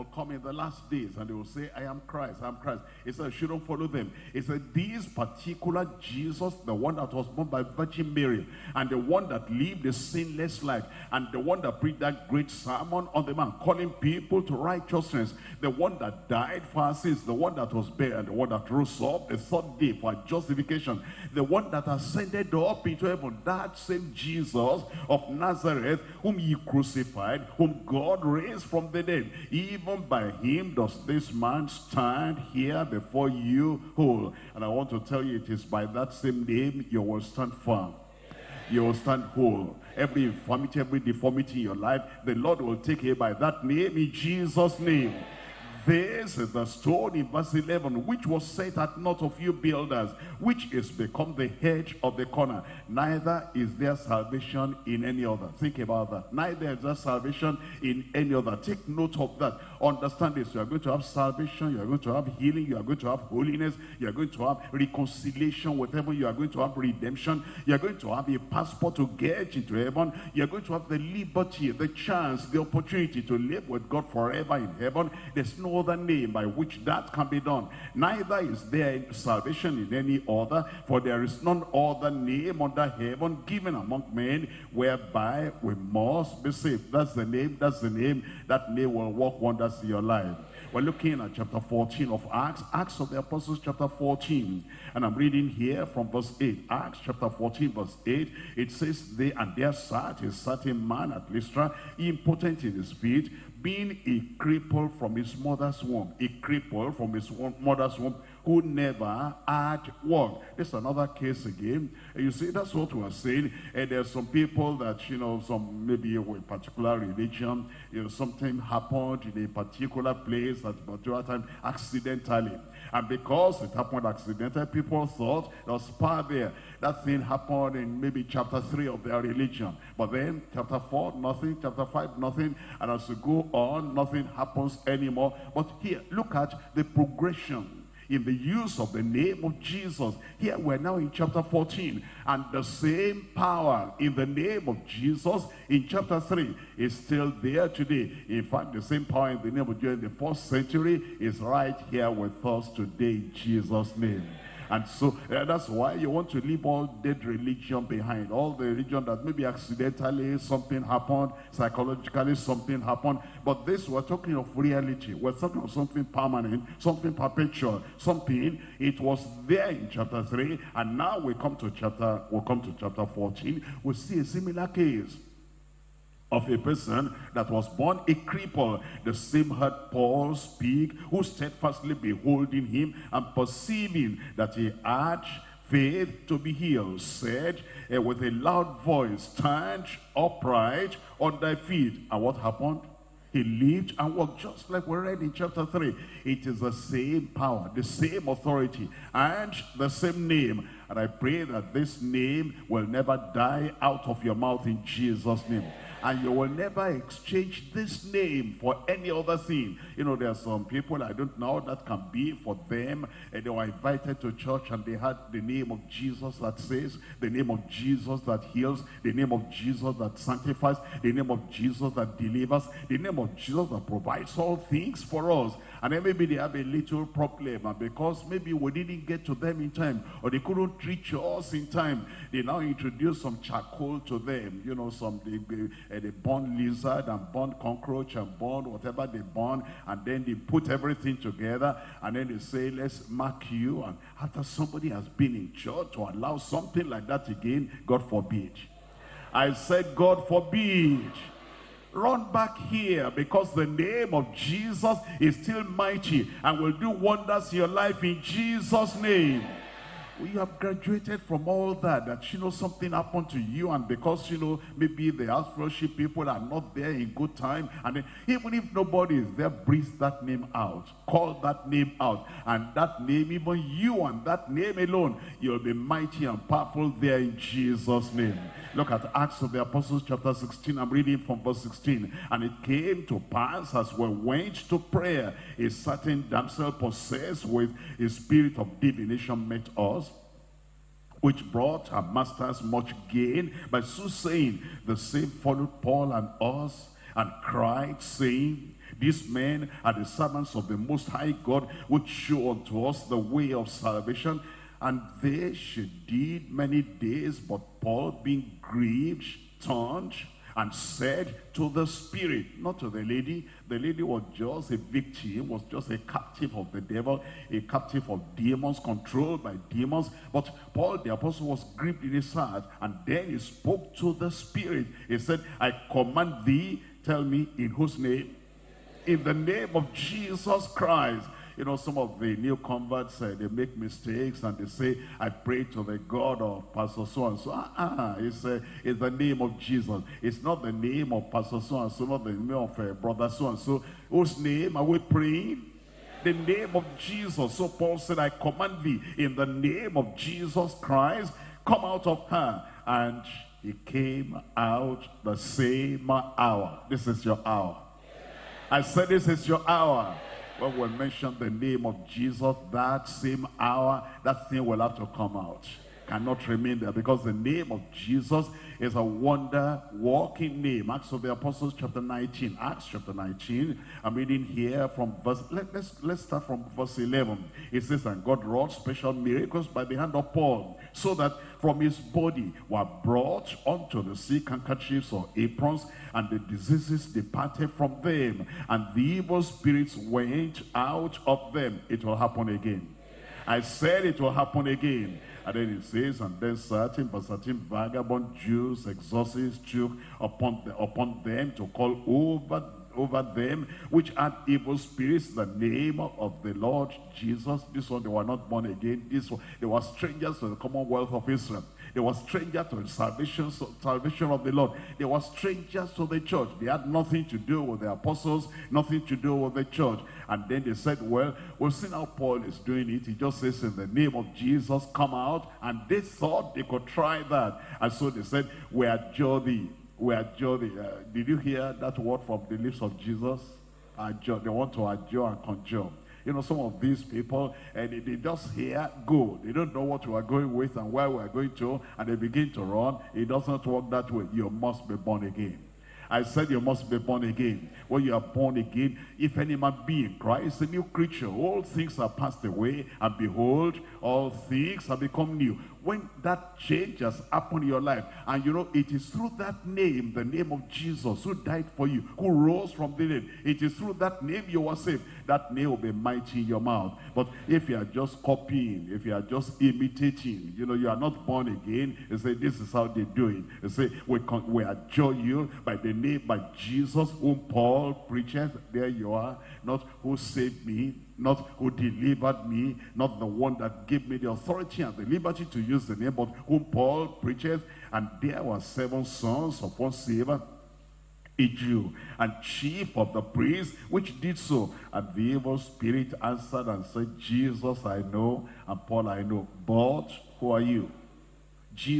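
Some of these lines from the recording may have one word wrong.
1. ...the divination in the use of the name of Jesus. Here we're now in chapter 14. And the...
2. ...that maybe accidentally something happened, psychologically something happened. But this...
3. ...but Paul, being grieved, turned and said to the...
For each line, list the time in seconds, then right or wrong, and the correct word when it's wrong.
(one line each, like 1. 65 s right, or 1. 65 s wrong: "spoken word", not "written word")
1. 136 s wrong: "progression", not "divination"
2. 159 s right
3. 307 s right.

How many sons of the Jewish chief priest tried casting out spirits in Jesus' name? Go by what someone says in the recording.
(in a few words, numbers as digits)
7.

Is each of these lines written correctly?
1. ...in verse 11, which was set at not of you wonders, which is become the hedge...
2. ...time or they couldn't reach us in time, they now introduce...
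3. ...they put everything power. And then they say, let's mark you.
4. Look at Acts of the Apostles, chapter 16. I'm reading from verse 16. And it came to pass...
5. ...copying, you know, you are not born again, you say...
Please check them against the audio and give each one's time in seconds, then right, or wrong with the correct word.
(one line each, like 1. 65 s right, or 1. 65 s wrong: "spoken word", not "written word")
1. 47 s wrong: "builders", not "wonders"
2. 229 s right
3. 240 s wrong: "together", not "power"
4. 278 s right
5. 469 s wrong: "imitating", not "copying".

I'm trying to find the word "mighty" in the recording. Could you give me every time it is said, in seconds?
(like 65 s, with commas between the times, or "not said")
255 s, 275 s, 465 s.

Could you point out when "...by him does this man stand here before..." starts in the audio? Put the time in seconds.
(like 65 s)
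30 s.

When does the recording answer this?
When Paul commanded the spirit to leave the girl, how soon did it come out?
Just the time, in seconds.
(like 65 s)
355 s.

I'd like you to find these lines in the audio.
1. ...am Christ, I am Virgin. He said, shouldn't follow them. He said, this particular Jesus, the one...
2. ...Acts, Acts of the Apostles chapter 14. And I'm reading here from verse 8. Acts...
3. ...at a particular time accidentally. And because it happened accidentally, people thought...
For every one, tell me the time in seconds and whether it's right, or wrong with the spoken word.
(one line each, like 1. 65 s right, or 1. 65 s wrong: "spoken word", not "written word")
1. 1 s wrong: "Christ", not "Virgin"
2. 92 s right
3. 120 s right.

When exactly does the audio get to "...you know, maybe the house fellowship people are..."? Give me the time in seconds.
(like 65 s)
264 s.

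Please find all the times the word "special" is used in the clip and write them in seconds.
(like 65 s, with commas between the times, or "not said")
378 s.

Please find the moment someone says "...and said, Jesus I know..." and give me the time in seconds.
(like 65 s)
496 s.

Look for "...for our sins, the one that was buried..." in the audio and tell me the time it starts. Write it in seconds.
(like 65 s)
16 s.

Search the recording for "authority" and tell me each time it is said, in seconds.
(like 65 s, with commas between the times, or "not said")
198 s, 484 s.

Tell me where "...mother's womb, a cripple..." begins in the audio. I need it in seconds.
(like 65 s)
105 s.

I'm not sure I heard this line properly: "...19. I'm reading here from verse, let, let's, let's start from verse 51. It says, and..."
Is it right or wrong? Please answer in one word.
wrong.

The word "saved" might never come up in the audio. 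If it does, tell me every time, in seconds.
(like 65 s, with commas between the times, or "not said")
86 s, 464 s, 480 s.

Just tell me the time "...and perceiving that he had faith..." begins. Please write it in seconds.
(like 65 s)
183 s.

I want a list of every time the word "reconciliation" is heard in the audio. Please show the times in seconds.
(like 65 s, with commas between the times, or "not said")
64 s.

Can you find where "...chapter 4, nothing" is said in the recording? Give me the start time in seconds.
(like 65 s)
130 s.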